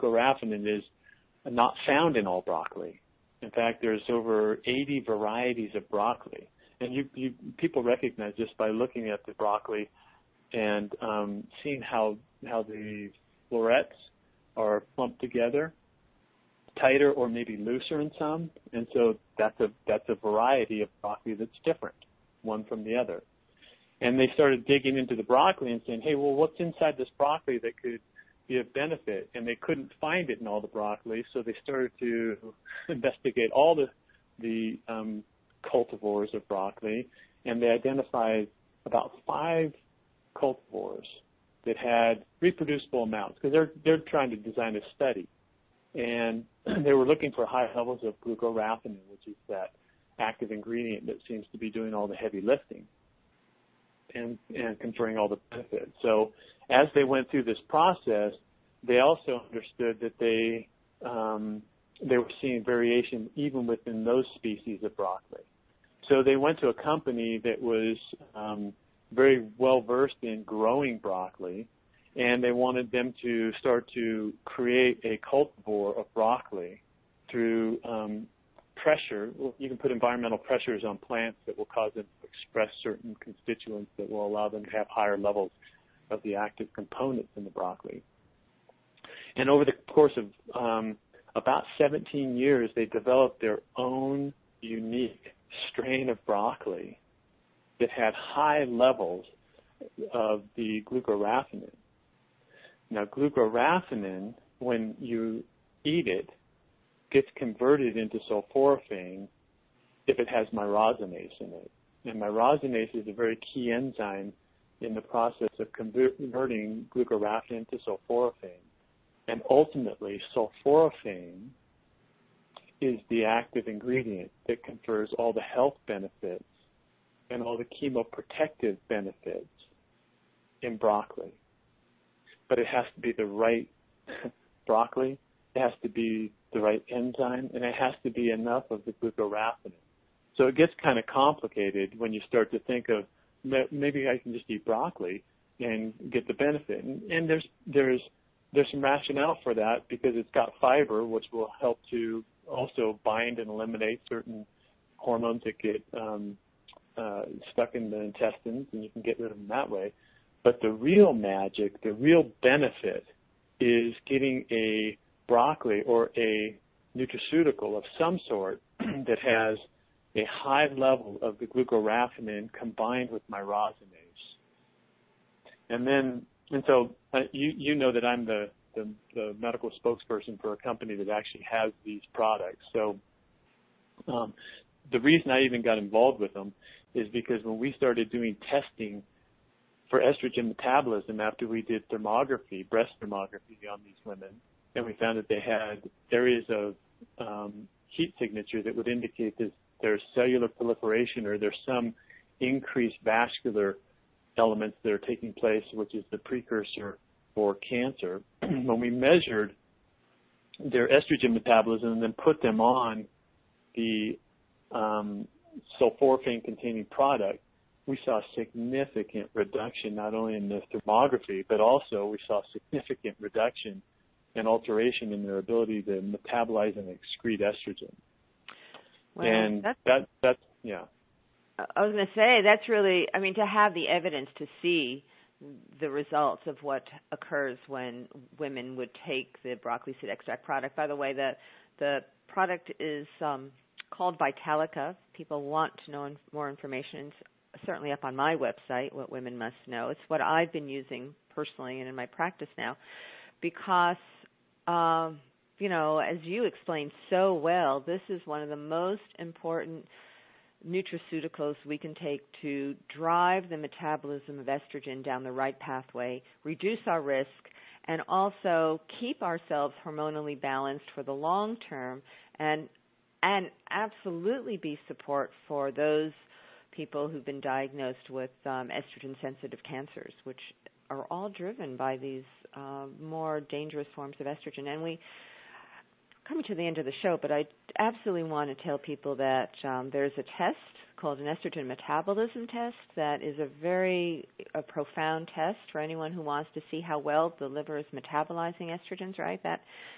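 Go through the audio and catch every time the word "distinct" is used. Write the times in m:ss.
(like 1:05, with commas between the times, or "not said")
not said.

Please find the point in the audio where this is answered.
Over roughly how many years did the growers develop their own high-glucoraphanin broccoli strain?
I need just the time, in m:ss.
1:31.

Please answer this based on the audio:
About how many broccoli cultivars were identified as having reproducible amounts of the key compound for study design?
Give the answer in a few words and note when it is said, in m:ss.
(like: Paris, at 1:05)
5, at 0:38.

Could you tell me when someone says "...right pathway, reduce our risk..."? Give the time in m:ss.
4:25.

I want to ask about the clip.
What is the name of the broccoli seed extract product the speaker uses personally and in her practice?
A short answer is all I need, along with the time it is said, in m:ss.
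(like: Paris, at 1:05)
Vitalica, at 4:04.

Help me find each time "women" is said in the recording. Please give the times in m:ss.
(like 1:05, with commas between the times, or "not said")
3:14, 3:58, 4:09.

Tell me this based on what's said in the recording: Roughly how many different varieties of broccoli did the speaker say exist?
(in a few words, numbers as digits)
over 80.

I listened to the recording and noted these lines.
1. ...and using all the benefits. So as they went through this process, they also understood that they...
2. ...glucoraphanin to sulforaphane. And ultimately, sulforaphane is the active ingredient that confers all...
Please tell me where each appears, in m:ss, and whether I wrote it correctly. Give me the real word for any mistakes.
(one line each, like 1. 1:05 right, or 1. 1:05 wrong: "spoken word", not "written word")
1. 0:54 wrong: "conferring", not "using"
2. 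1:56 right.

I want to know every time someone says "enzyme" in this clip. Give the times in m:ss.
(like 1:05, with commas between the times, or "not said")
1:53, 2:16.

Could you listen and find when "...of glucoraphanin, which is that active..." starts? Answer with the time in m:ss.
0:48.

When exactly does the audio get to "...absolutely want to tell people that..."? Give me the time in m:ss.
4:47.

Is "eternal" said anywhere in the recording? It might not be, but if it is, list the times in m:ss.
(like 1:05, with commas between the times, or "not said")
not said.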